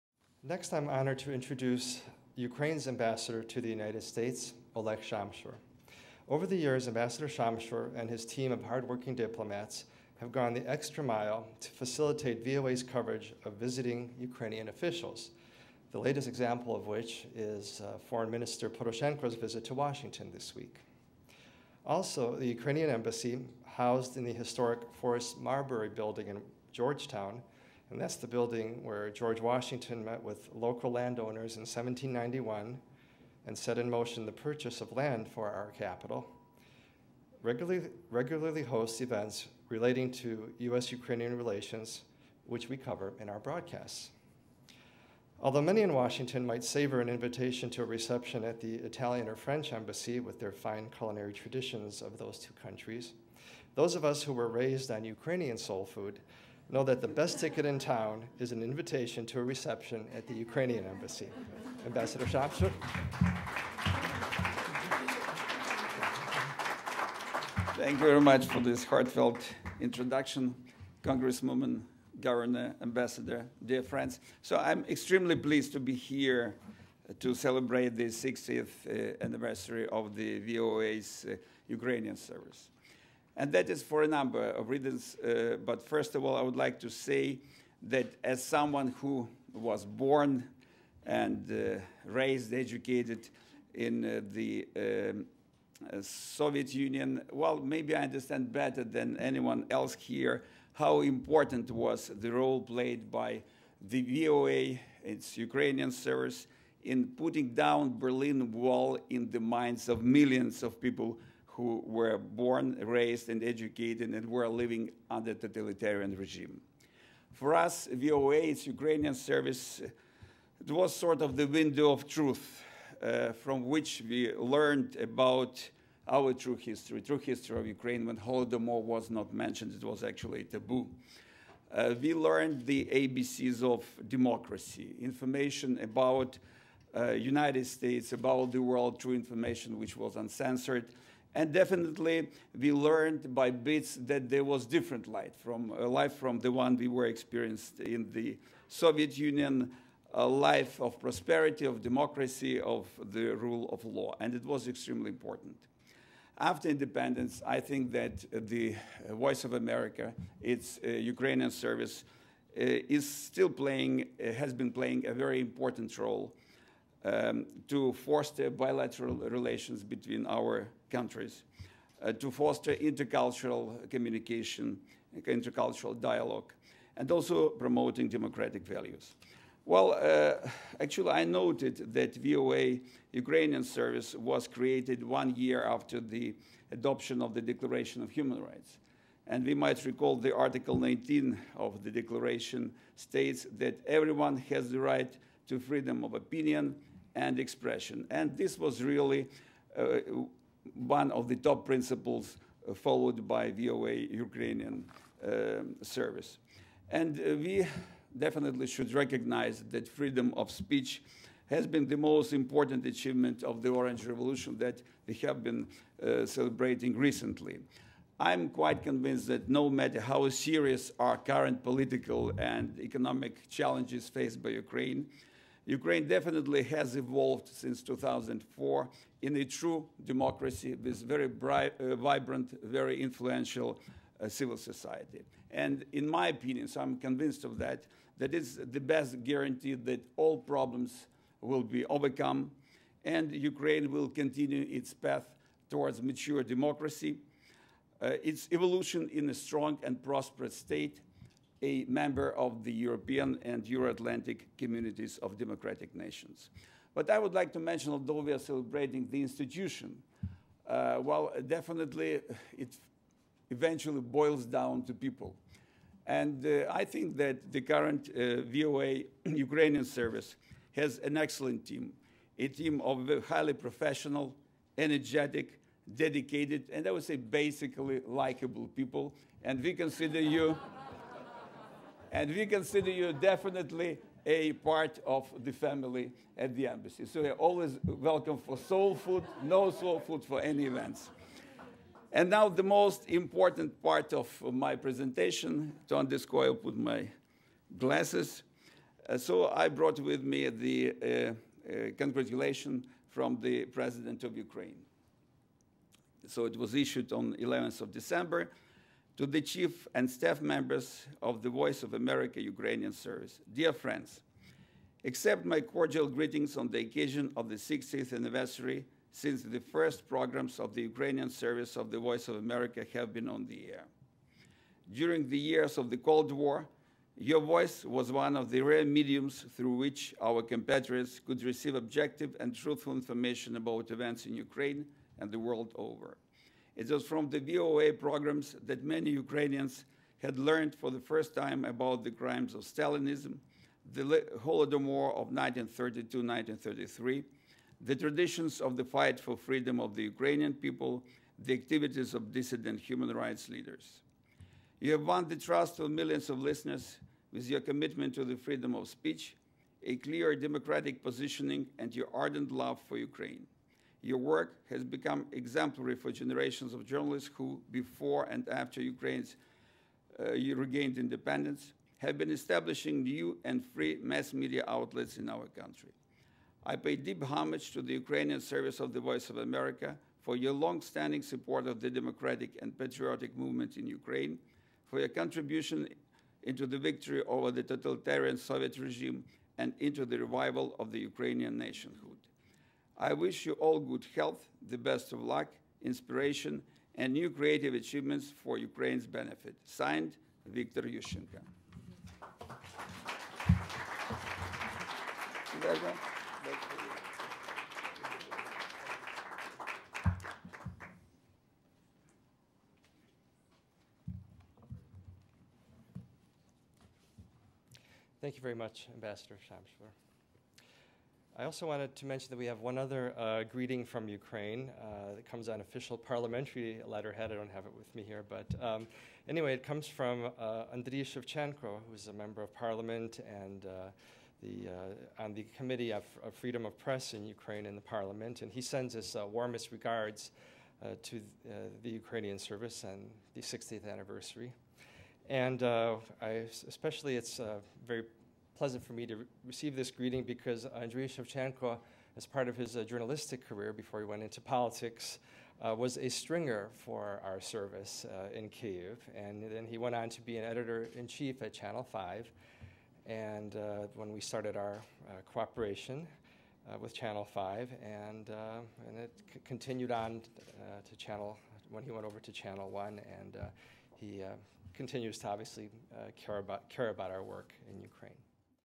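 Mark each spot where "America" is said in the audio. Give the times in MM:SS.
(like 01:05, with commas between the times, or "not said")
02:39, 05:11, 05:22, 06:19.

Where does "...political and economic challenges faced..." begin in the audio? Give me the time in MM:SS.
03:41.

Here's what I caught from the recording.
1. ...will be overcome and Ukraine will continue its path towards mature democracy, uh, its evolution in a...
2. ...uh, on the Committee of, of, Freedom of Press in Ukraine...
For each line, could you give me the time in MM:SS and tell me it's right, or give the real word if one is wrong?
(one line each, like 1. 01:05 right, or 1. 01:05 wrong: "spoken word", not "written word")
1. 04:01 right
2. 07:14 right.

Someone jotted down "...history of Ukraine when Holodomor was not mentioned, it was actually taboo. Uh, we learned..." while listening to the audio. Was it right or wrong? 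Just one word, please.
right.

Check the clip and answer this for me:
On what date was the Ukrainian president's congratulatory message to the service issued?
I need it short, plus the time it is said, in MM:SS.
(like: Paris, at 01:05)
11 December, at 05:07.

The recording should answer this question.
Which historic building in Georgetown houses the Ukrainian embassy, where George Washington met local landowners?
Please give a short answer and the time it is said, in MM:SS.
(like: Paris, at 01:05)
Forrest Marbury building, at 00:24.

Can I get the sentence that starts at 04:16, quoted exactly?
But I would like to mention, although we are celebrating the institution, uh, well, definitely it eventually boils down to people.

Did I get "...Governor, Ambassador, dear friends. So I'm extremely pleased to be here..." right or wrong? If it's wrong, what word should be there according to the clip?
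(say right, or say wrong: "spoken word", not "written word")
right.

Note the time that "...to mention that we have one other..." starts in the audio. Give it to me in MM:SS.
07:01.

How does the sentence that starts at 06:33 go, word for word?
I wish you all good health, the best of luck, inspiration, and new creative achievements for Ukraine's benefit.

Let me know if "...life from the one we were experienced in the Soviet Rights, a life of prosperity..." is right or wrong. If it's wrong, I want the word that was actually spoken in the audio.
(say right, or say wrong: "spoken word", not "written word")
wrong: "Union", not "Rights".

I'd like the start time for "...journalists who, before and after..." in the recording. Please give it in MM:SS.
06:06.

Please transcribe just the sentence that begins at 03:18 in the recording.
And this was really uh, one of the top principles uh, followed by VOA Ukrainian um, service.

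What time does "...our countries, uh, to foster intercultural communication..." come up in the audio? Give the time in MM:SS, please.
02:50.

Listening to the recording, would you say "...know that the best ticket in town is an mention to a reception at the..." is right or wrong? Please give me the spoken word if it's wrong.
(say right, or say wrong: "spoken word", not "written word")
wrong: "invitation", not "mention".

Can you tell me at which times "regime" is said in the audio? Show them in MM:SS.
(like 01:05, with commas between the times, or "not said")
01:56, 06:28.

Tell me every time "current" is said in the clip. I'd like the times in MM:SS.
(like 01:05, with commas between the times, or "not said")
03:41, 04:27.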